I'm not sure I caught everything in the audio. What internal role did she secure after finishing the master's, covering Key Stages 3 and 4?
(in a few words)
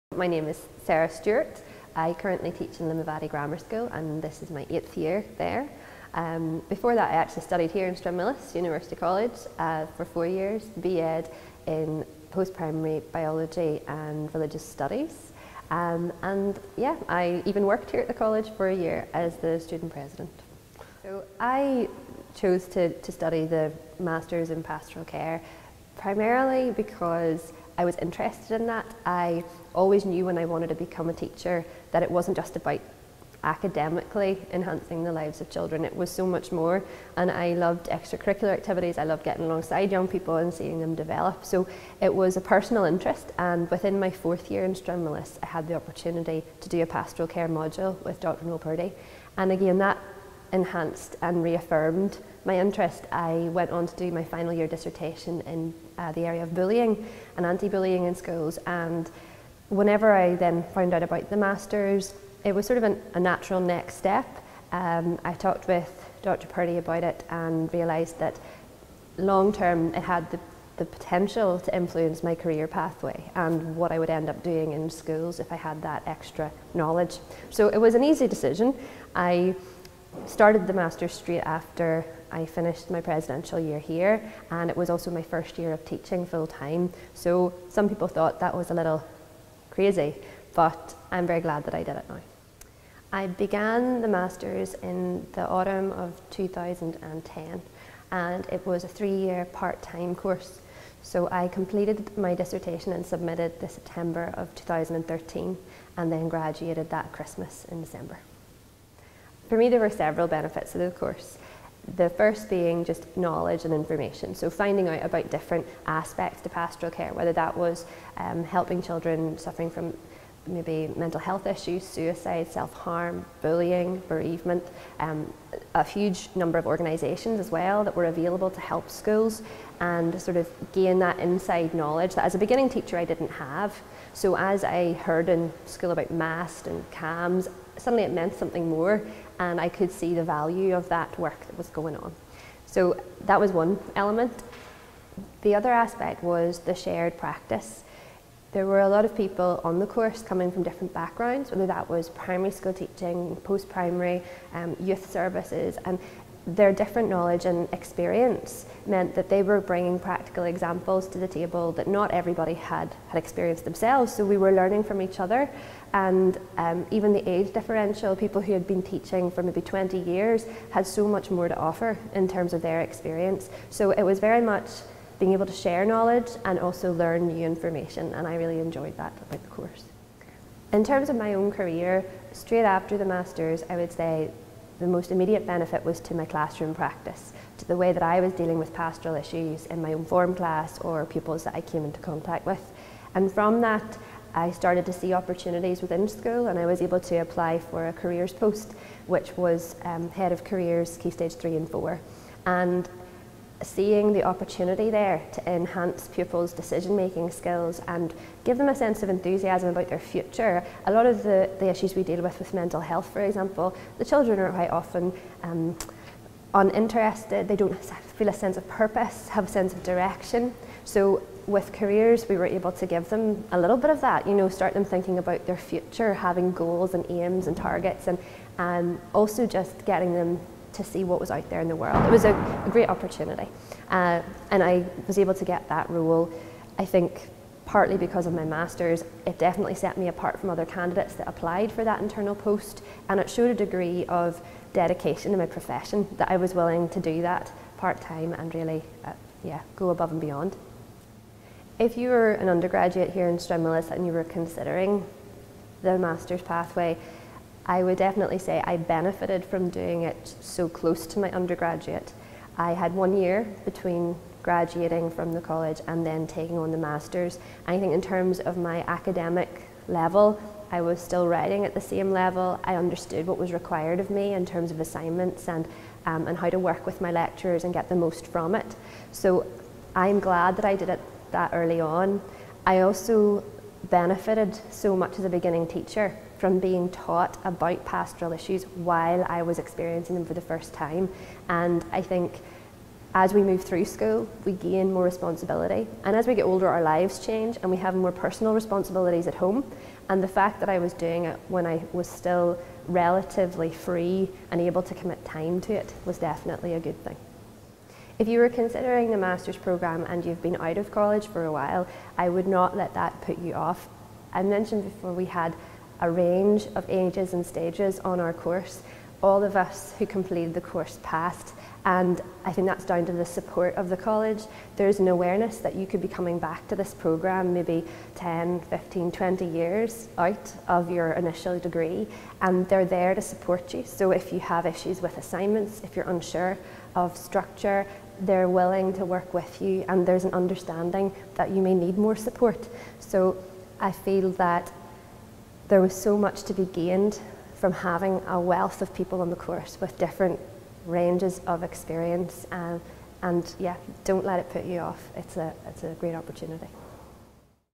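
Head of careers.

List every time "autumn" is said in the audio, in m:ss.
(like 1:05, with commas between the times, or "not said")
1:35.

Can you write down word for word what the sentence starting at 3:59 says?
It definitely set me apart from other candidates that applied for that internal post.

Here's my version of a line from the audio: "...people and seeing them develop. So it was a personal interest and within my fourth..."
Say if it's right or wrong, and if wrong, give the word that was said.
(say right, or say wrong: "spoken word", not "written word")
right.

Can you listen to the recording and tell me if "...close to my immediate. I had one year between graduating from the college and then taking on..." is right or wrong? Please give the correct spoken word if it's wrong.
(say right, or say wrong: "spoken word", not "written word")
wrong: "undergraduate", not "immediate".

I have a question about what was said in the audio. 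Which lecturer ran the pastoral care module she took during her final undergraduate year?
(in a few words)
Dr Noel Purdy.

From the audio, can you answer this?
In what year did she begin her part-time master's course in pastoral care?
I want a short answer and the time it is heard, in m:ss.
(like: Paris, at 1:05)
2010, at 1:36.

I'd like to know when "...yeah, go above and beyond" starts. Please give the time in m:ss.
4:09.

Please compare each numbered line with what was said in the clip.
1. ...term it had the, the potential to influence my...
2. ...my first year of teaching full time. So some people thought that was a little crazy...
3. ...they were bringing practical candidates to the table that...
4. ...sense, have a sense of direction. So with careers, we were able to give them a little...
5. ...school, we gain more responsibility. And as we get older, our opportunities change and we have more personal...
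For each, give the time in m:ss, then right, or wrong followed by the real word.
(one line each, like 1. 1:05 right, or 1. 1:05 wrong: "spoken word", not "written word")
1. 1:09 right
2. 1:25 right
3. 2:39 wrong: "examples", not "candidates"
4. 3:38 wrong: "purpose", not "sense"
5. 4:53 wrong: "lives", not "opportunities".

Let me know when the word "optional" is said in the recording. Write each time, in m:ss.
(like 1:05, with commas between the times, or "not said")
not said.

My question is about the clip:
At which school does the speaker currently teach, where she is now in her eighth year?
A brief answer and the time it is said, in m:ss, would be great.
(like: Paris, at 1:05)
Limavady Grammar School, at 0:02.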